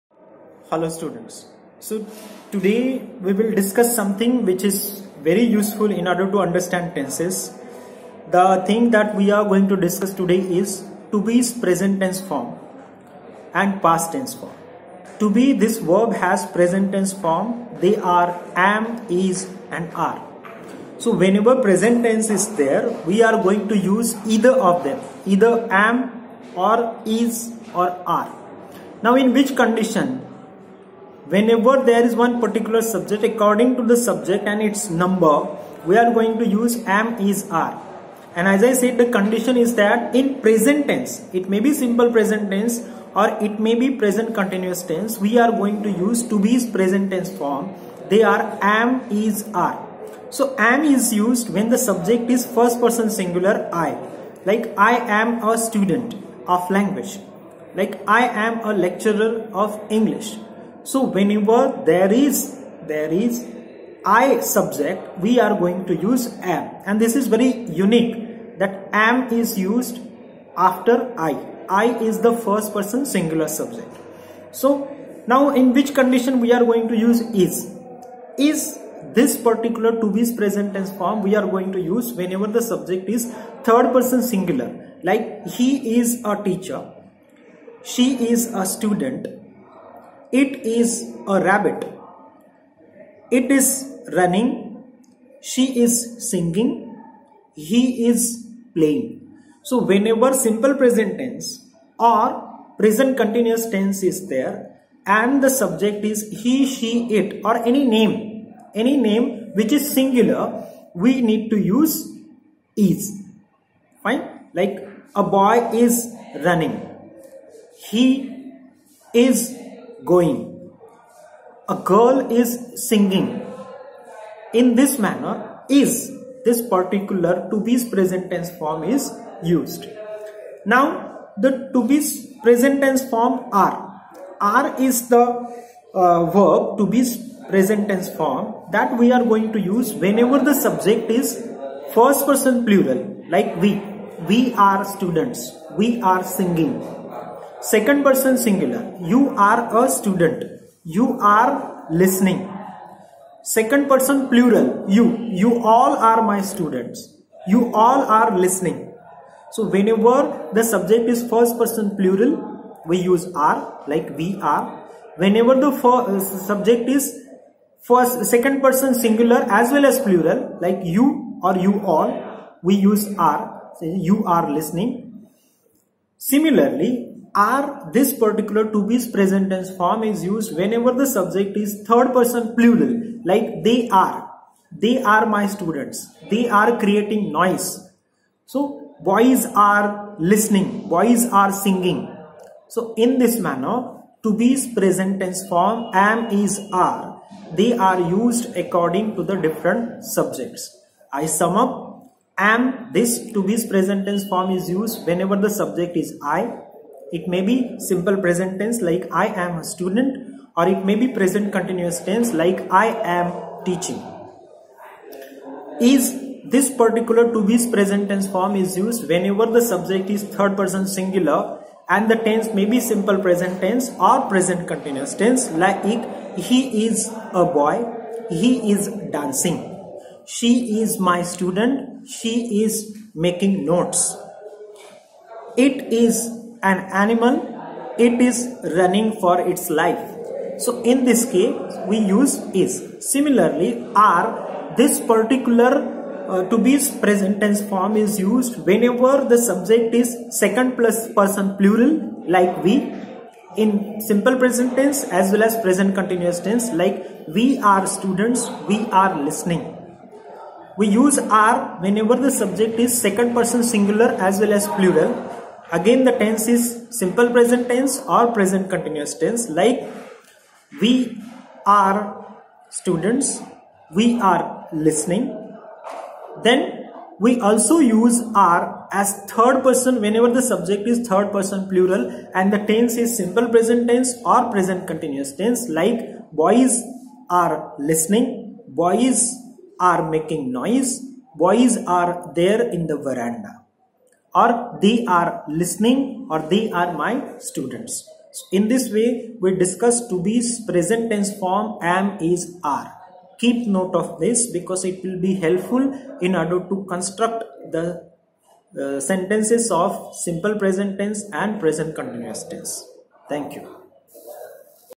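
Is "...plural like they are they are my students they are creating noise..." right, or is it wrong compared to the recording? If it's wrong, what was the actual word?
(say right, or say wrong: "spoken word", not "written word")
right.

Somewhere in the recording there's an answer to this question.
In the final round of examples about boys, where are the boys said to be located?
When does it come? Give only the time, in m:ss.
4:51.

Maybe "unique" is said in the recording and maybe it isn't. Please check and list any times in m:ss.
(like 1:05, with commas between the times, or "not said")
1:07.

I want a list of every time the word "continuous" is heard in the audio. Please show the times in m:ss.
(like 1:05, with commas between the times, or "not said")
0:44, 1:43, 3:31, 3:44, 4:15, 4:28, 4:44, 5:11.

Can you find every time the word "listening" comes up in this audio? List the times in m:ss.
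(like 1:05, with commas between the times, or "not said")
2:31, 2:38, 2:54, 3:10, 4:19, 4:34, 4:47, 4:55.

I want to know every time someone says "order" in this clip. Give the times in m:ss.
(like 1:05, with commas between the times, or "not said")
0:06, 5:06.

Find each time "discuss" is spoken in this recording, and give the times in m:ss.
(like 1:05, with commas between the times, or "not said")
0:03, 0:09, 4:59.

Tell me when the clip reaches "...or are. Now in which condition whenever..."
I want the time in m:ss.
0:27.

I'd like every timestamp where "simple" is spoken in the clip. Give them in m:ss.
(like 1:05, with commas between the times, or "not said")
0:41, 1:40, 3:27, 3:42, 4:14, 4:26, 4:43, 5:10.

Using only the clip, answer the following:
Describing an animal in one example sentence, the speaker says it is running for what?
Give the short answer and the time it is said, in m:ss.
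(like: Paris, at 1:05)
its life, at 3:57.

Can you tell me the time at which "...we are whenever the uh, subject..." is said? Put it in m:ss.
2:44.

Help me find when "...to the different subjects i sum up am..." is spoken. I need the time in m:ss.
3:19.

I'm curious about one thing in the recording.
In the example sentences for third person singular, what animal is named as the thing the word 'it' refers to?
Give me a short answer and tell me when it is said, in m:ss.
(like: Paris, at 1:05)
rabbit, at 1:30.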